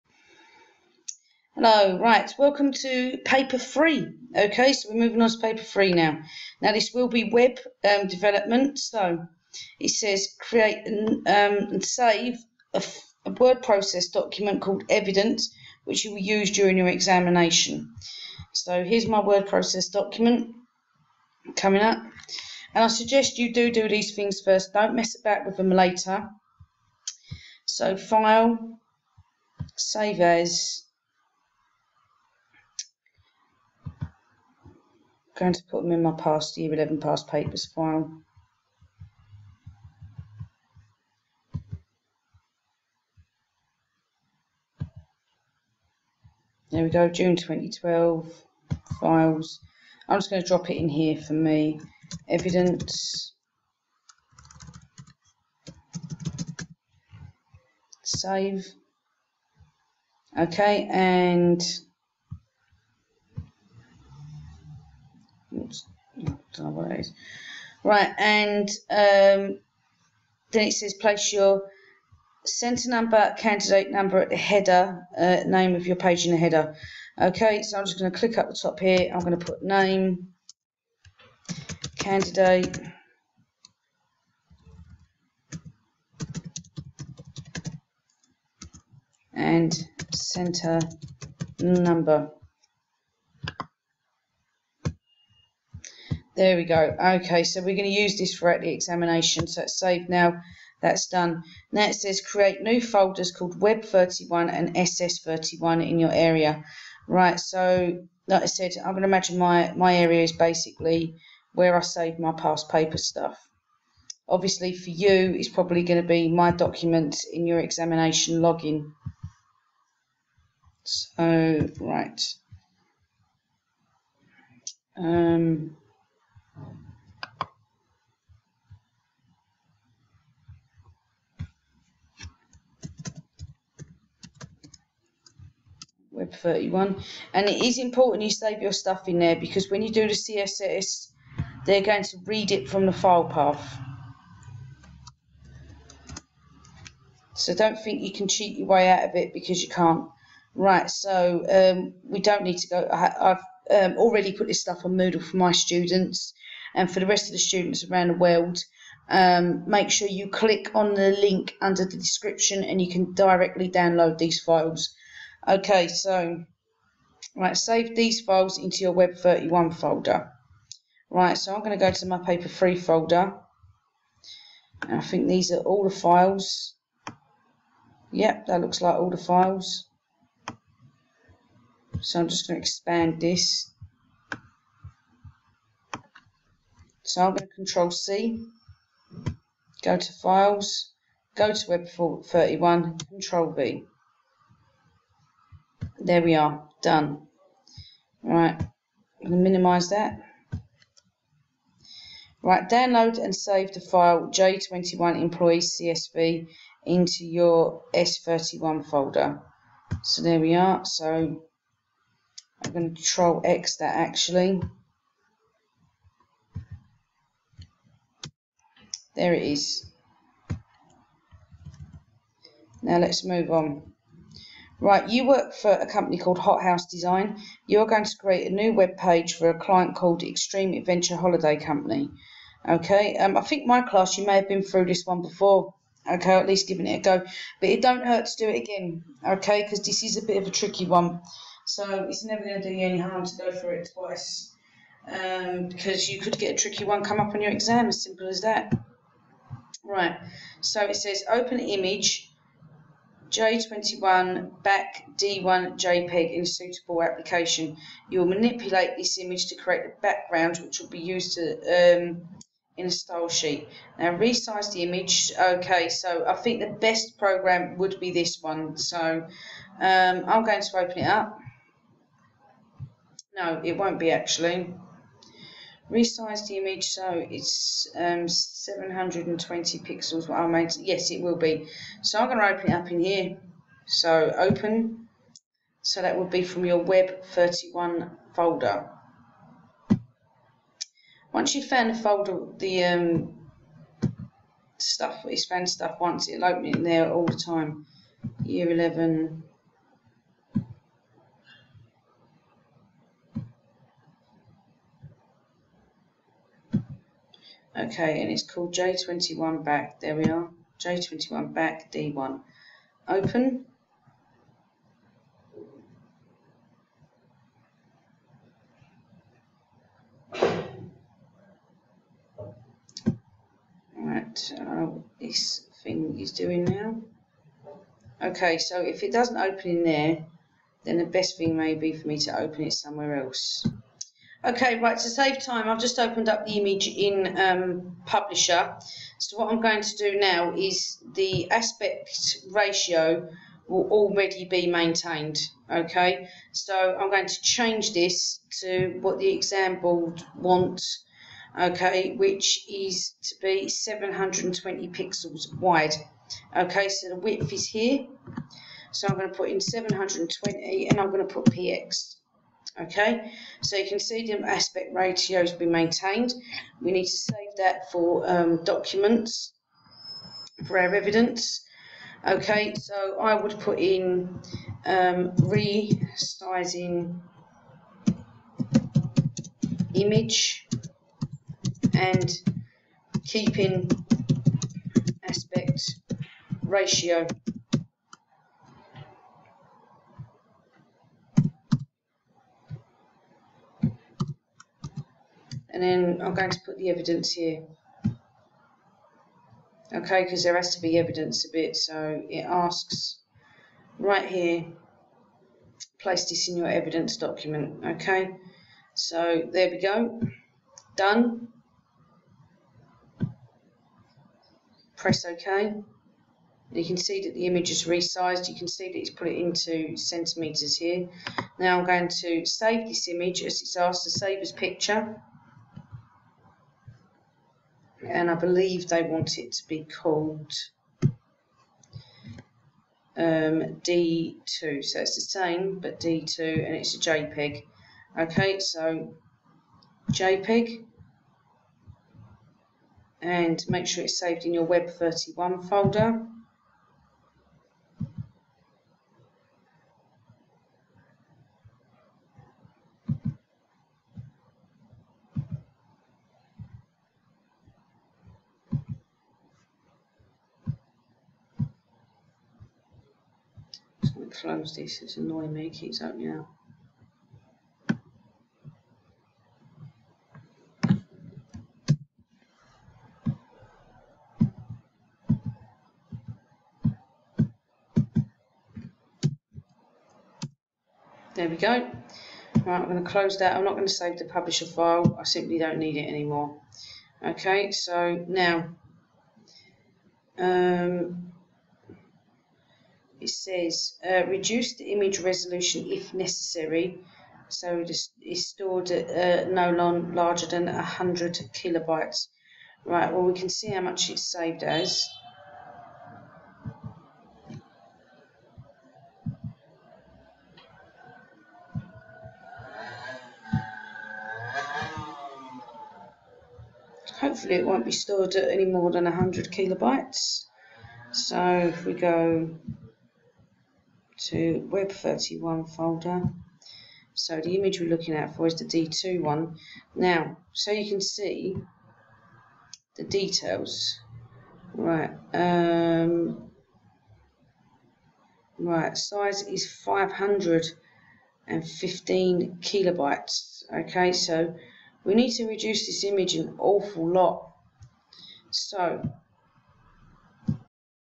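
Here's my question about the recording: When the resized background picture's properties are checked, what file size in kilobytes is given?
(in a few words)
515.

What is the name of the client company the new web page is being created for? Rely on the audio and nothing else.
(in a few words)
Extreme Adventure Holiday Company.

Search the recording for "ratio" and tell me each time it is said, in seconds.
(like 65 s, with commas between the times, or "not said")
342 s, 364 s, 386 s.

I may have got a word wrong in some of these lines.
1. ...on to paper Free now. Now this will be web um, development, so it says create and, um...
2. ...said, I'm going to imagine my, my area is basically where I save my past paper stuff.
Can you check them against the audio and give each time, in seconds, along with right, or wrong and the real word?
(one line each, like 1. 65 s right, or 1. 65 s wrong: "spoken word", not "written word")
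1. 5 s right
2. 108 s right.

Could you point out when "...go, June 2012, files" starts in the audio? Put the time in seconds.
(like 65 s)
46 s.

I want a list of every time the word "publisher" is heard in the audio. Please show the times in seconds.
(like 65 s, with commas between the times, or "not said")
338 s, 484 s.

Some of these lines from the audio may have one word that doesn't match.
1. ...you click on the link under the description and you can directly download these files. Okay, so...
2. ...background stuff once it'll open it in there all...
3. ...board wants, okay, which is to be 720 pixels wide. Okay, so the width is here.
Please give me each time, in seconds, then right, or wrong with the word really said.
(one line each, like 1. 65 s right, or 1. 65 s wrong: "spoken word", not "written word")
1. 160 s right
2. 295 s wrong: "found", not "background"
3. 349 s right.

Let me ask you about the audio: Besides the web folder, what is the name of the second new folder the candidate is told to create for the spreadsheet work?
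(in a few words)
SS31.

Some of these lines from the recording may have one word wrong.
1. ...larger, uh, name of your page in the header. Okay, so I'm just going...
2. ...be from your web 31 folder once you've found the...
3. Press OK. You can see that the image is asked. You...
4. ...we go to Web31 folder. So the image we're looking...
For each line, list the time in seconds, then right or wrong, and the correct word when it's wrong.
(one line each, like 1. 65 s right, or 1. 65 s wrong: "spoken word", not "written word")
1. 74 s wrong: "header", not "larger"
2. 286 s right
3. 414 s wrong: "resized", not "asked"
4. 521 s right.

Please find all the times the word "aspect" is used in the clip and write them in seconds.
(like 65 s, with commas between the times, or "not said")
341 s, 364 s, 385 s.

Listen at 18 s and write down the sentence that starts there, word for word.
So here's my word process document coming up.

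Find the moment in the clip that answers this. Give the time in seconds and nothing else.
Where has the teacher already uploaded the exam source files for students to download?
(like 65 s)
154 s.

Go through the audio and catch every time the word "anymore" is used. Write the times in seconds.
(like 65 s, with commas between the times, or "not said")
486 s.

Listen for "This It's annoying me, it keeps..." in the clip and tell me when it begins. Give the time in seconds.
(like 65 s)
464 s.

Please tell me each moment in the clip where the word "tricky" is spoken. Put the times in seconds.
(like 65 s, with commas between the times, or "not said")
240 s, 246 s.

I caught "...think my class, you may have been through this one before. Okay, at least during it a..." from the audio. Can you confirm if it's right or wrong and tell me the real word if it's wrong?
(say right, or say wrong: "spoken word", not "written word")
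wrong: "giving", not "during".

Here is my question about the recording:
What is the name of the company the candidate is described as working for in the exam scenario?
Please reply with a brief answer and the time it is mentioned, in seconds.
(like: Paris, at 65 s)
Hot House Design, at 226 s.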